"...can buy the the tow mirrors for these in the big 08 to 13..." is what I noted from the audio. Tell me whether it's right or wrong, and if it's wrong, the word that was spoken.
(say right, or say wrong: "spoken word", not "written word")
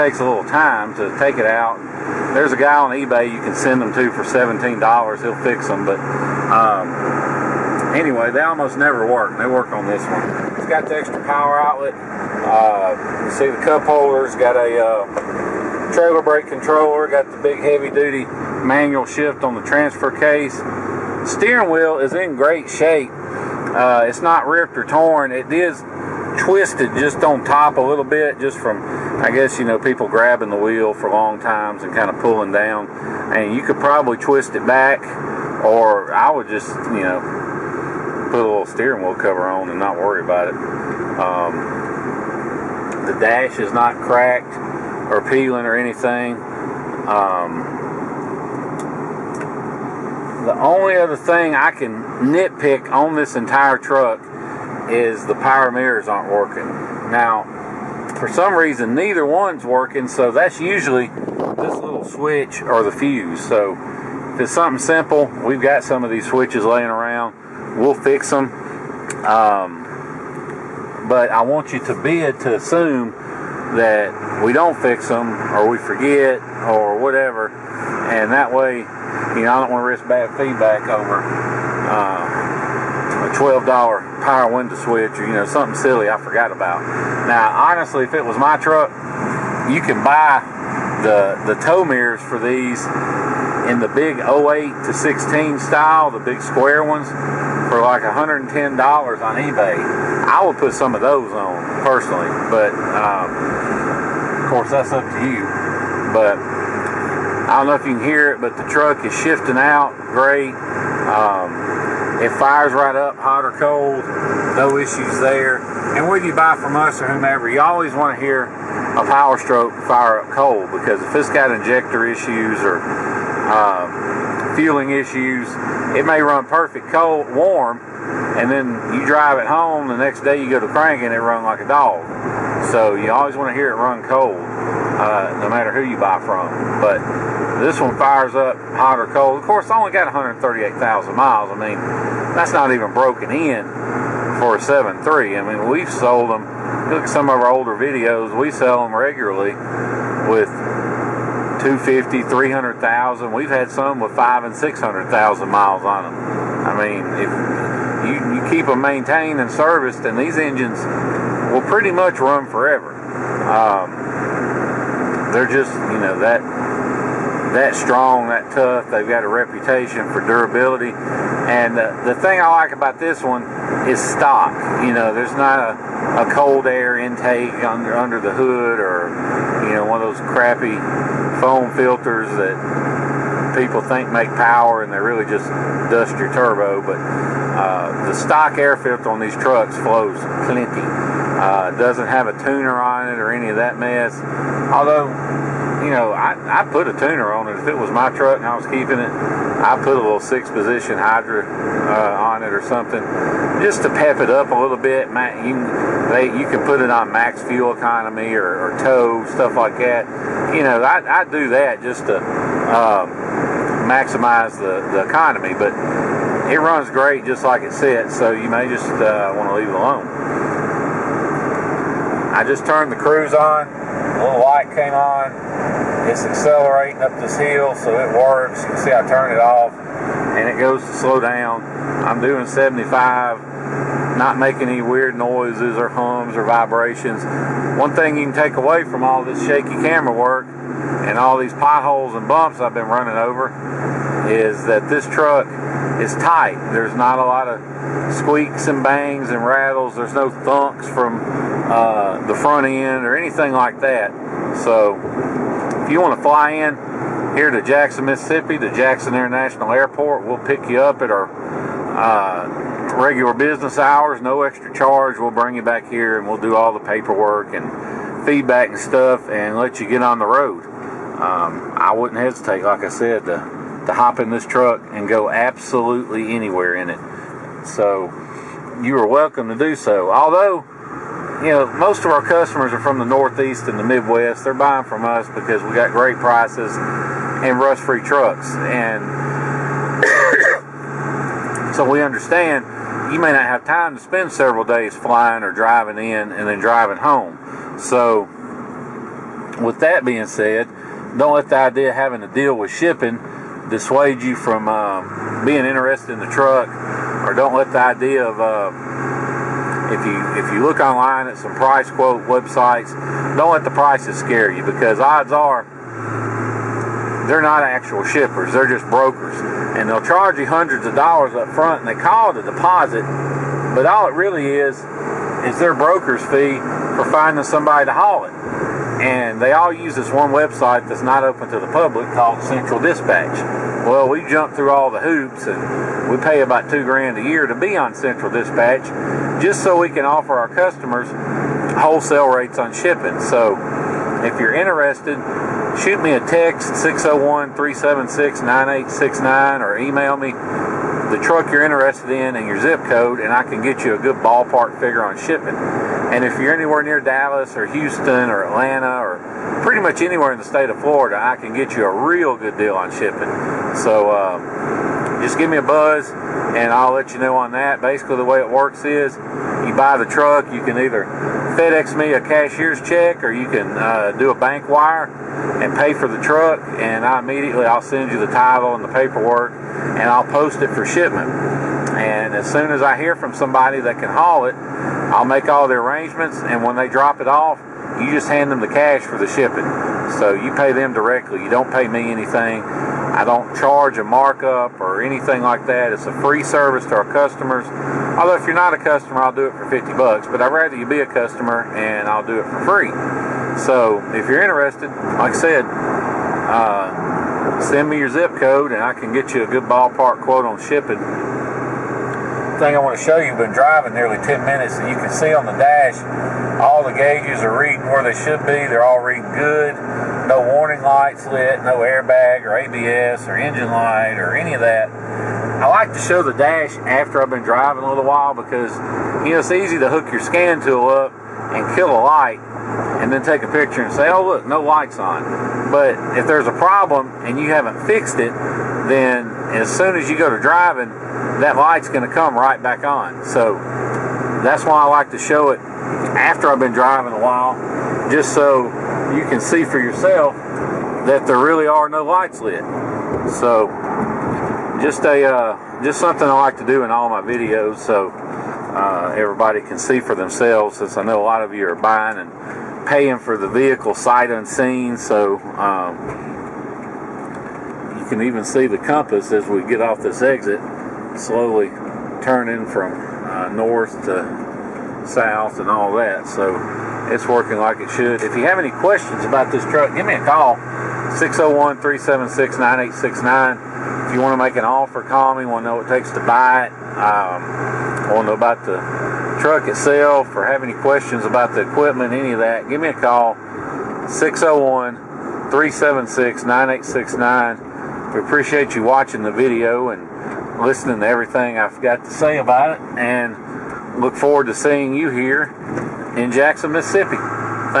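wrong: "16", not "13".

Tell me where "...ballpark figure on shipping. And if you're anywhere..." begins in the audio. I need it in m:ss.
5:54.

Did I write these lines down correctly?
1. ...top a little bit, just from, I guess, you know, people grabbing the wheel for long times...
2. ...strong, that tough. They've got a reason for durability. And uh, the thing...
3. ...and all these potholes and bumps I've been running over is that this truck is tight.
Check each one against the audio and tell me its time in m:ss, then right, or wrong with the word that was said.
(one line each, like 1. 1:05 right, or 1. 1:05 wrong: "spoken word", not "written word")
1. 0:27 right
2. 2:47 wrong: "reputation", not "reason"
3. 4:00 right.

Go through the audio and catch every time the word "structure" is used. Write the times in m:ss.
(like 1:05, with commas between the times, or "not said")
not said.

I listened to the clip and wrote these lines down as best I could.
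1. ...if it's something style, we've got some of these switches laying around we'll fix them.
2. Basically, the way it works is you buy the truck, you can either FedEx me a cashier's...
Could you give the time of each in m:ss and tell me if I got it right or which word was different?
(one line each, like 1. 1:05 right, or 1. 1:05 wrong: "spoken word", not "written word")
1. 1:04 wrong: "simple", not "style"
2. 6:07 right.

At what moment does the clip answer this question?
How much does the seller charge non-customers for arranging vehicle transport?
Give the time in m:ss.
6:39.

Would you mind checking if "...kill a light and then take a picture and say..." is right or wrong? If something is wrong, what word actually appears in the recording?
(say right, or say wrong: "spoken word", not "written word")
right.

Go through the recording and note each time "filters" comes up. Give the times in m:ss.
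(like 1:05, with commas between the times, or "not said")
3:01, 3:08.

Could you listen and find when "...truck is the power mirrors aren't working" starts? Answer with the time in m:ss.
0:53.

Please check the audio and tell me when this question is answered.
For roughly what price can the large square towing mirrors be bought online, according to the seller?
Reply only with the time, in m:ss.
1:38.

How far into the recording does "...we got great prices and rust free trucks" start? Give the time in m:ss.
4:45.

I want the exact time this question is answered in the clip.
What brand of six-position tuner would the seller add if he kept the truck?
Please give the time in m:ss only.
3:20.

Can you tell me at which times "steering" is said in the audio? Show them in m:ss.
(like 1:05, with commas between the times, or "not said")
0:21, 0:38.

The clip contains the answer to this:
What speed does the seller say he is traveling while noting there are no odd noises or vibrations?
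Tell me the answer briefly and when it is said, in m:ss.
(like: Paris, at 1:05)
75, at 3:52.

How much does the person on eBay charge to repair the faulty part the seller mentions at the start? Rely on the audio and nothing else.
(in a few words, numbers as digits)
$17.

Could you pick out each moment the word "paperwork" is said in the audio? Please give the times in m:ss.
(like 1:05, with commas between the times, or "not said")
4:26, 6:18.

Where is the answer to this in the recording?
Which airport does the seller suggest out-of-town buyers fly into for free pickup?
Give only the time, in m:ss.
4:18.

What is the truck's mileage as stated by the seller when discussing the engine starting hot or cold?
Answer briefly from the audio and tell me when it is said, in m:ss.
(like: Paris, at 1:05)
138,000, at 2:20.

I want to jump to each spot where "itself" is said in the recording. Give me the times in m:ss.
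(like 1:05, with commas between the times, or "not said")
8:09.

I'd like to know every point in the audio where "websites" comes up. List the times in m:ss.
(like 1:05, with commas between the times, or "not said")
5:12, 5:30.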